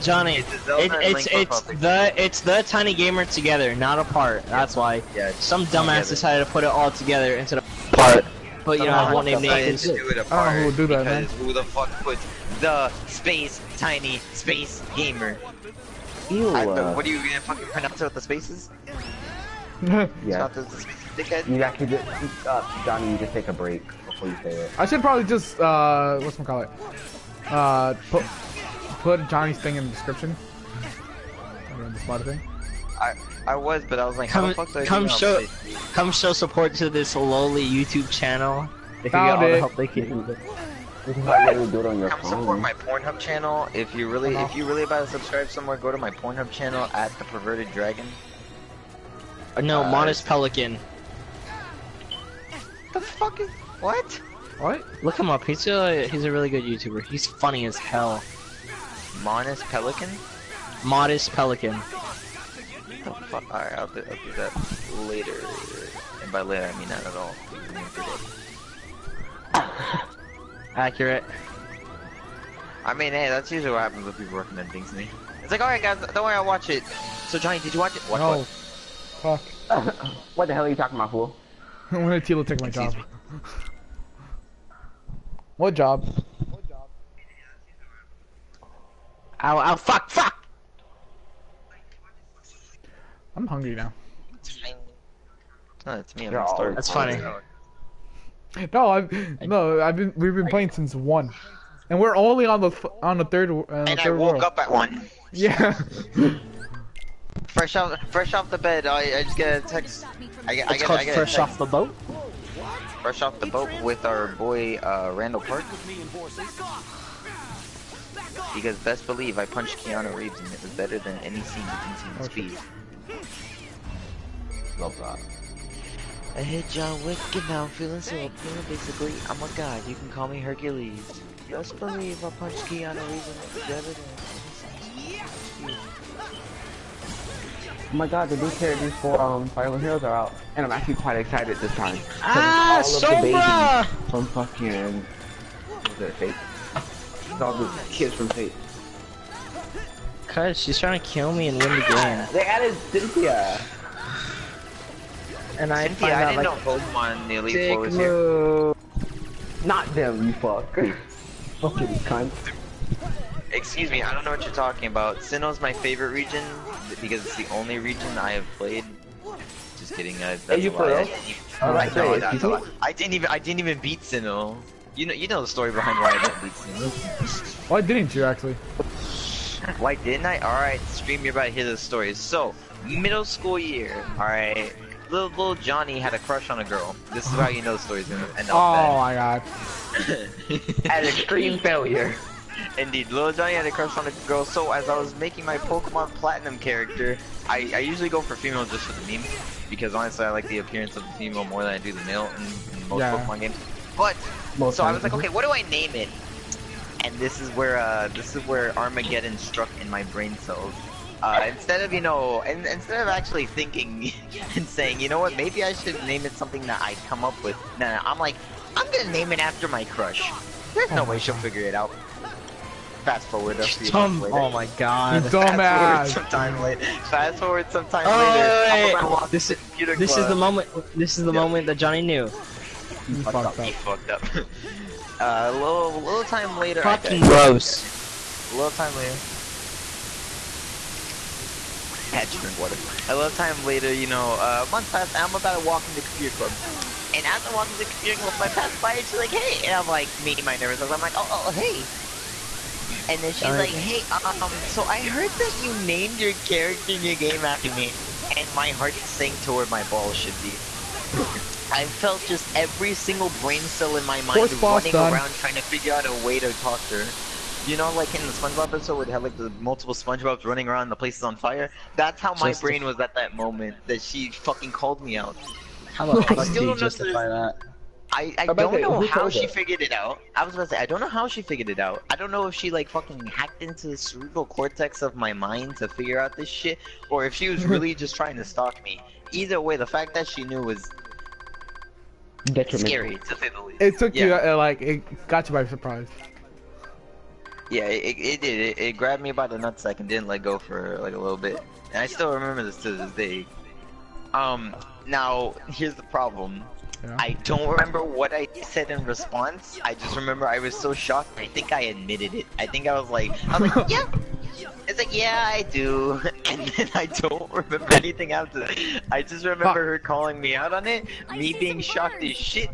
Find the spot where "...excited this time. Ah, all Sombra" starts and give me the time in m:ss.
2:21.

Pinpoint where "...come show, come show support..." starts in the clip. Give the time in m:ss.
0:34.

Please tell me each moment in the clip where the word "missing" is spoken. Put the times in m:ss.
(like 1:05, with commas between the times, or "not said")
not said.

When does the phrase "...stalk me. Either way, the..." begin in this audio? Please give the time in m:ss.
4:48.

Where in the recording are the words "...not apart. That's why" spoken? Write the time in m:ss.
0:03.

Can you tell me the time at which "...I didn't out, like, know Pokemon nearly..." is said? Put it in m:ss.
2:36.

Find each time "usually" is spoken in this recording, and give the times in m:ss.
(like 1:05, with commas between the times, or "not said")
1:13, 3:17.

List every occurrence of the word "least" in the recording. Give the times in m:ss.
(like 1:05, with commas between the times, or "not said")
4:53.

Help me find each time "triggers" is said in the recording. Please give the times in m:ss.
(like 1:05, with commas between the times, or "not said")
not said.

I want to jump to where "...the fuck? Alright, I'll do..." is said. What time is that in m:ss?
1:03.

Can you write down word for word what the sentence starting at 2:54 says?
You know you know the story behind why I didn't beat Sinnoh.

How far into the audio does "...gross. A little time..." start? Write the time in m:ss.
3:57.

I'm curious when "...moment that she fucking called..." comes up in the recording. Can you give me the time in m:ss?
4:33.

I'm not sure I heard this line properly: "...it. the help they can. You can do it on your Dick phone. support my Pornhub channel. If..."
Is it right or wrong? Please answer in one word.
wrong.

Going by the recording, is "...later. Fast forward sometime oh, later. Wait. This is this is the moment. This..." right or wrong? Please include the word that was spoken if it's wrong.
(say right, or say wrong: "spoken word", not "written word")
right.